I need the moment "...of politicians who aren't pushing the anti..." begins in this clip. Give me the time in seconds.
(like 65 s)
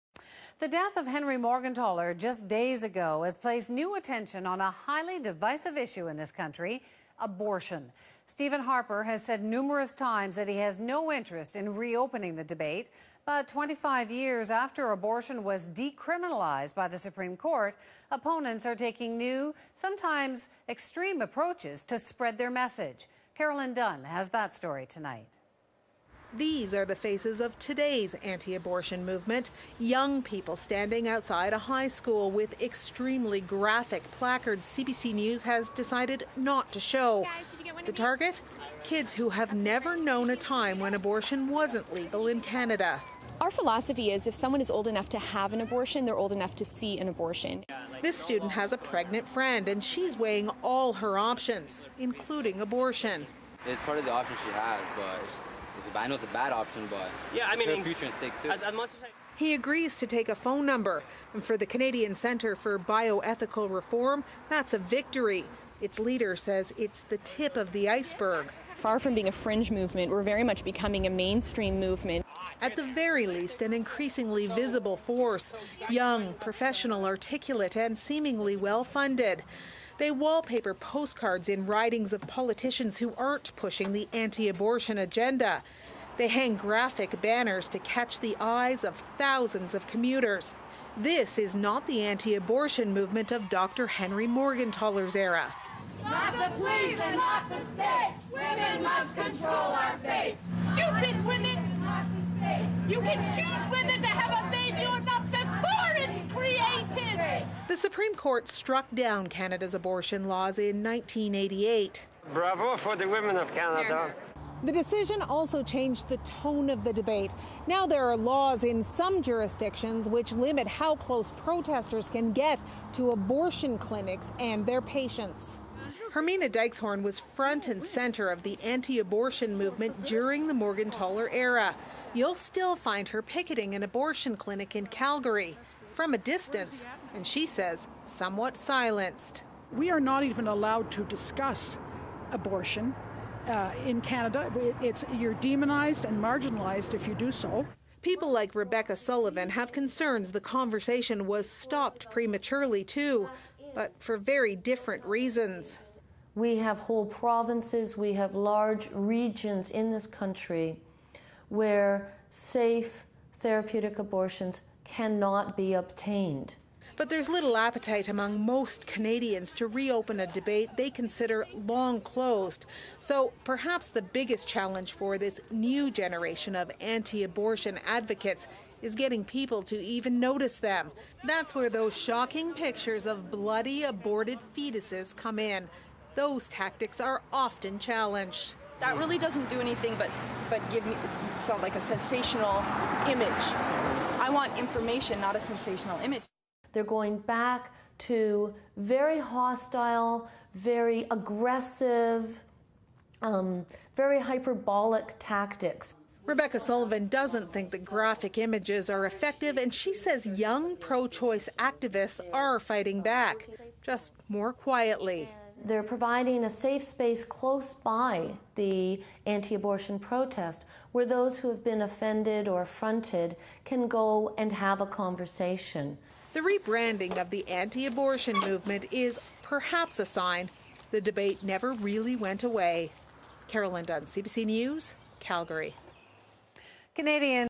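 82 s.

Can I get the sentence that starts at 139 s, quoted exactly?
We are not even allowed to discuss abortion uh, in Canada.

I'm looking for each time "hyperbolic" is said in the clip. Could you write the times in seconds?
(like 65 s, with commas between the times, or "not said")
204 s.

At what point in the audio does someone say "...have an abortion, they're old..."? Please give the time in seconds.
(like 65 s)
45 s.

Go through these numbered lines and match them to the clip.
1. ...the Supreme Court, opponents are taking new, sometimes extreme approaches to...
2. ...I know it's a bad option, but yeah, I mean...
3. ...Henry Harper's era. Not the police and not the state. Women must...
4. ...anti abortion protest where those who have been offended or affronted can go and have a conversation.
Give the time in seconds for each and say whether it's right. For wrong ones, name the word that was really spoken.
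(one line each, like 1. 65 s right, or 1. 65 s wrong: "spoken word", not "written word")
1. 16 s right
2. 55 s right
3. 93 s wrong: "Morgentaler", not "Harper"
4. 219 s right.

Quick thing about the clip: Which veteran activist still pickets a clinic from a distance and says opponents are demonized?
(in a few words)
Hermina Dykxhoorn.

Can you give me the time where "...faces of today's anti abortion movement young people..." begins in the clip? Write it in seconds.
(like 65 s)
26 s.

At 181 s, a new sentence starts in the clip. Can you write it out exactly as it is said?
That's where those shocking pictures of bloody aborted fetuses come in.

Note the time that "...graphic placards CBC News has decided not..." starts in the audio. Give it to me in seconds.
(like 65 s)
33 s.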